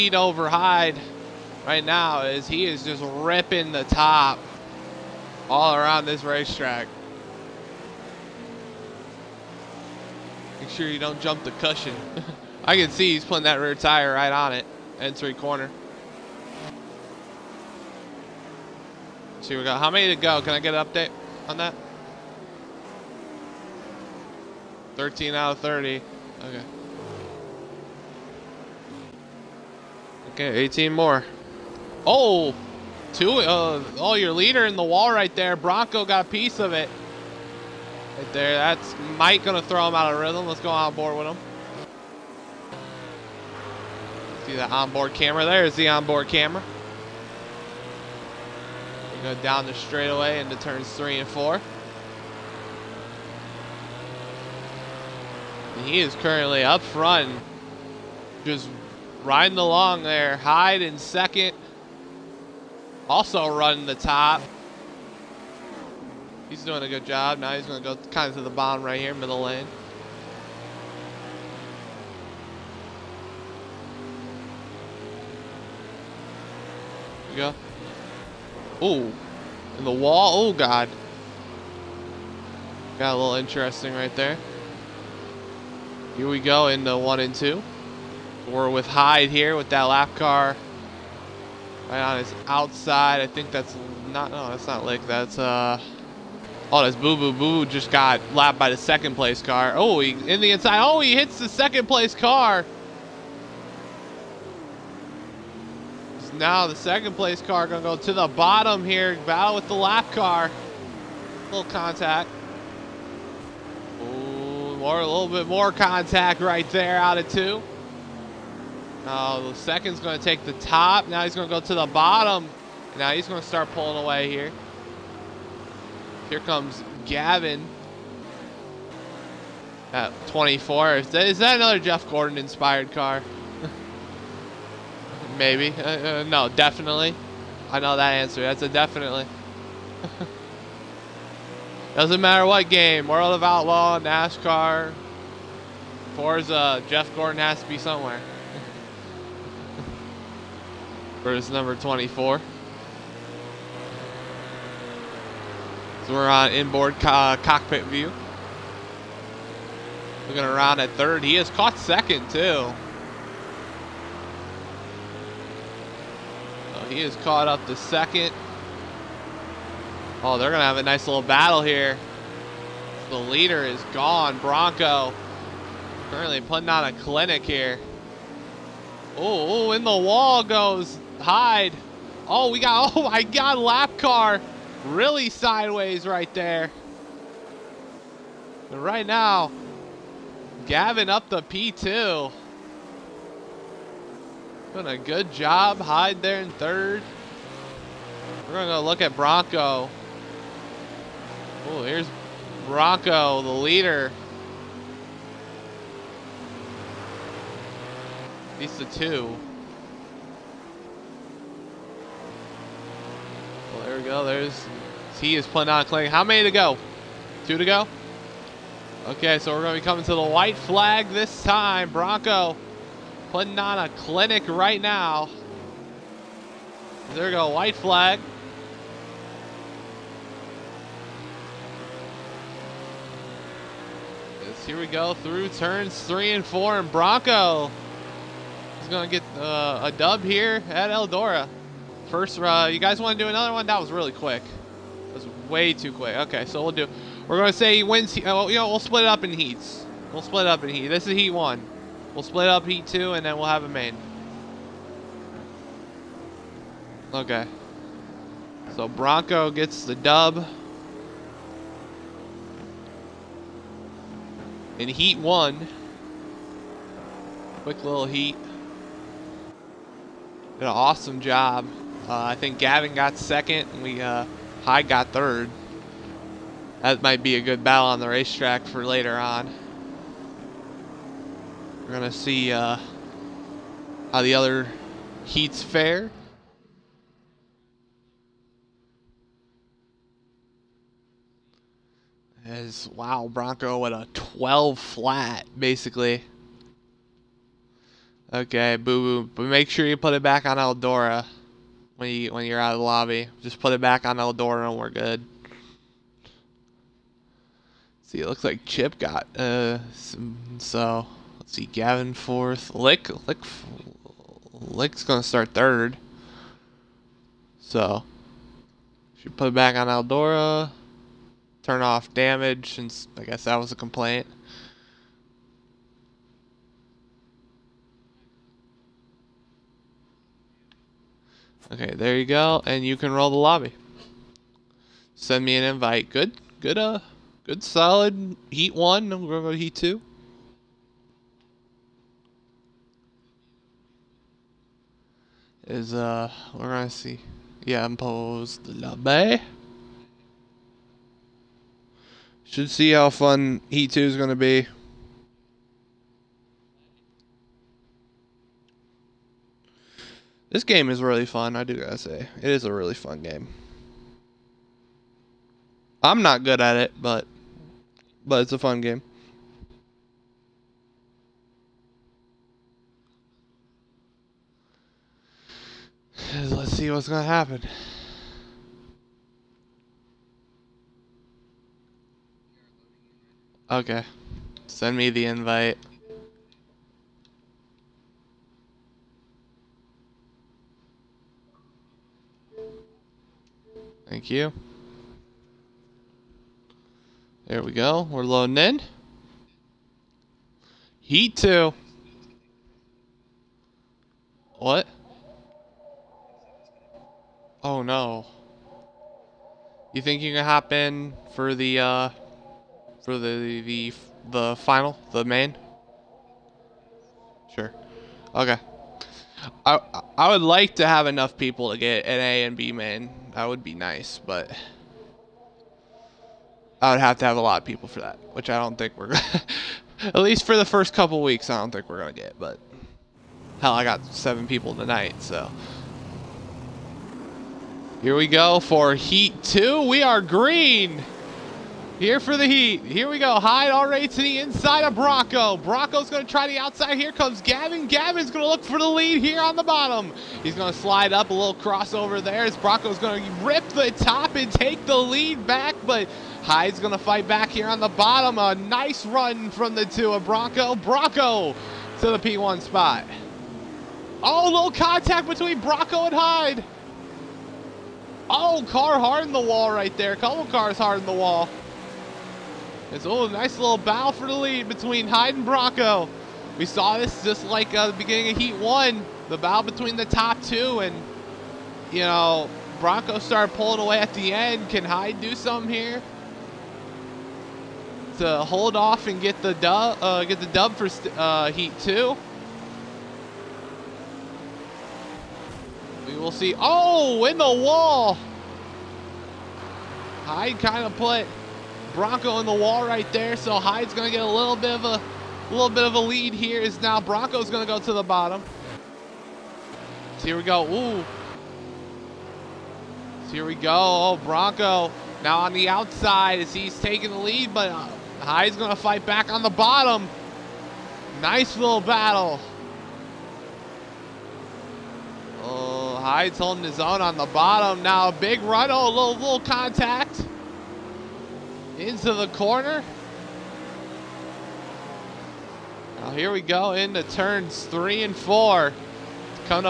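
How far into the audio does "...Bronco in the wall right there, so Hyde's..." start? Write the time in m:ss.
8:21.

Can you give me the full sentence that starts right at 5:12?
Lick Lick Lick's gonna start third.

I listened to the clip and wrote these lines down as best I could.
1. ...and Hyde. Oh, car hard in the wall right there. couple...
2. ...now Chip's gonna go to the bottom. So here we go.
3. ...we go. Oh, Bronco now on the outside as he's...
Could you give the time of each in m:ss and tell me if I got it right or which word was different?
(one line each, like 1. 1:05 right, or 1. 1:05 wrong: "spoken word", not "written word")
1. 7:46 right
2. 8:26 wrong: "Bronco", not "Chip"
3. 8:33 right.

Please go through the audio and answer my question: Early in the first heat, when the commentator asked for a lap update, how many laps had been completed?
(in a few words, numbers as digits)
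13.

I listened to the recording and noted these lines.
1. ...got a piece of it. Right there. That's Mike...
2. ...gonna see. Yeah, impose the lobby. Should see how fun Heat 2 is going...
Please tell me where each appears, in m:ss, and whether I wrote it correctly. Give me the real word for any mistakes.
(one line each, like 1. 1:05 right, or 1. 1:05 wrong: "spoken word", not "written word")
1. 0:36 right
2. 5:46 right.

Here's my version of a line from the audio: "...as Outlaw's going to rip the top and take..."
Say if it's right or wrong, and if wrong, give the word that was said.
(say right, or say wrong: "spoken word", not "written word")
wrong: "Bronco", not "Outlaw".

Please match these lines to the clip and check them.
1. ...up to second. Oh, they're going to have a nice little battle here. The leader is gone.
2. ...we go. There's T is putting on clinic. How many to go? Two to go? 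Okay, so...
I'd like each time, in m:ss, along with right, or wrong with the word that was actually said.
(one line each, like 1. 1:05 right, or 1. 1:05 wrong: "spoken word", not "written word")
1. 2:47 right
2. 3:33 right.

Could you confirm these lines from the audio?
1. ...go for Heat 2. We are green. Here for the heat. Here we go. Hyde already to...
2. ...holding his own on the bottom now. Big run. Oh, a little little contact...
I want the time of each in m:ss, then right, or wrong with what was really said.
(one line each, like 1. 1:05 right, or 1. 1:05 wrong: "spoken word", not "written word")
1. 7:18 right
2. 8:46 right.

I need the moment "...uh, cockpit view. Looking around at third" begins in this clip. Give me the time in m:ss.
2:37.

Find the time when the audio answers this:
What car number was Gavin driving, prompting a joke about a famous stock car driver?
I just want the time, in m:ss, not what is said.
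2:06.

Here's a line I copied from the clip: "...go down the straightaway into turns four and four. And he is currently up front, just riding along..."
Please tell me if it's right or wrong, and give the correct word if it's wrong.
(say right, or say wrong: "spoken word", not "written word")
wrong: "three", not "four".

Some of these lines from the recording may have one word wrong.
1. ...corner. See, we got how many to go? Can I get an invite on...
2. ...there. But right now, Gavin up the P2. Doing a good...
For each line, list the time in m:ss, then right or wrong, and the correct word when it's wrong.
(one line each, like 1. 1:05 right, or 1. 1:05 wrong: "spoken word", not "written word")
1. 0:15 wrong: "update", not "invite"
2. 3:06 right.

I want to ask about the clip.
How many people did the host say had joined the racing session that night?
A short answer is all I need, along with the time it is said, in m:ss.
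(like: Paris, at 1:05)
7, at 7:14.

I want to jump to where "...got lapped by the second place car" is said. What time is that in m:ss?
1:37.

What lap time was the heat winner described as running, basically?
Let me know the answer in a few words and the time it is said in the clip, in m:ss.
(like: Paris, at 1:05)
12 flat, at 4:54.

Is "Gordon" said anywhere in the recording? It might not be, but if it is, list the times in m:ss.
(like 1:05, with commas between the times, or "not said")
2:12, 2:27.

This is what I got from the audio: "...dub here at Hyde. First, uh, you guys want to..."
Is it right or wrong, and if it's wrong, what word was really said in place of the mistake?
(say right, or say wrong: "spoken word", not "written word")
wrong: "Eldora", not "Hyde".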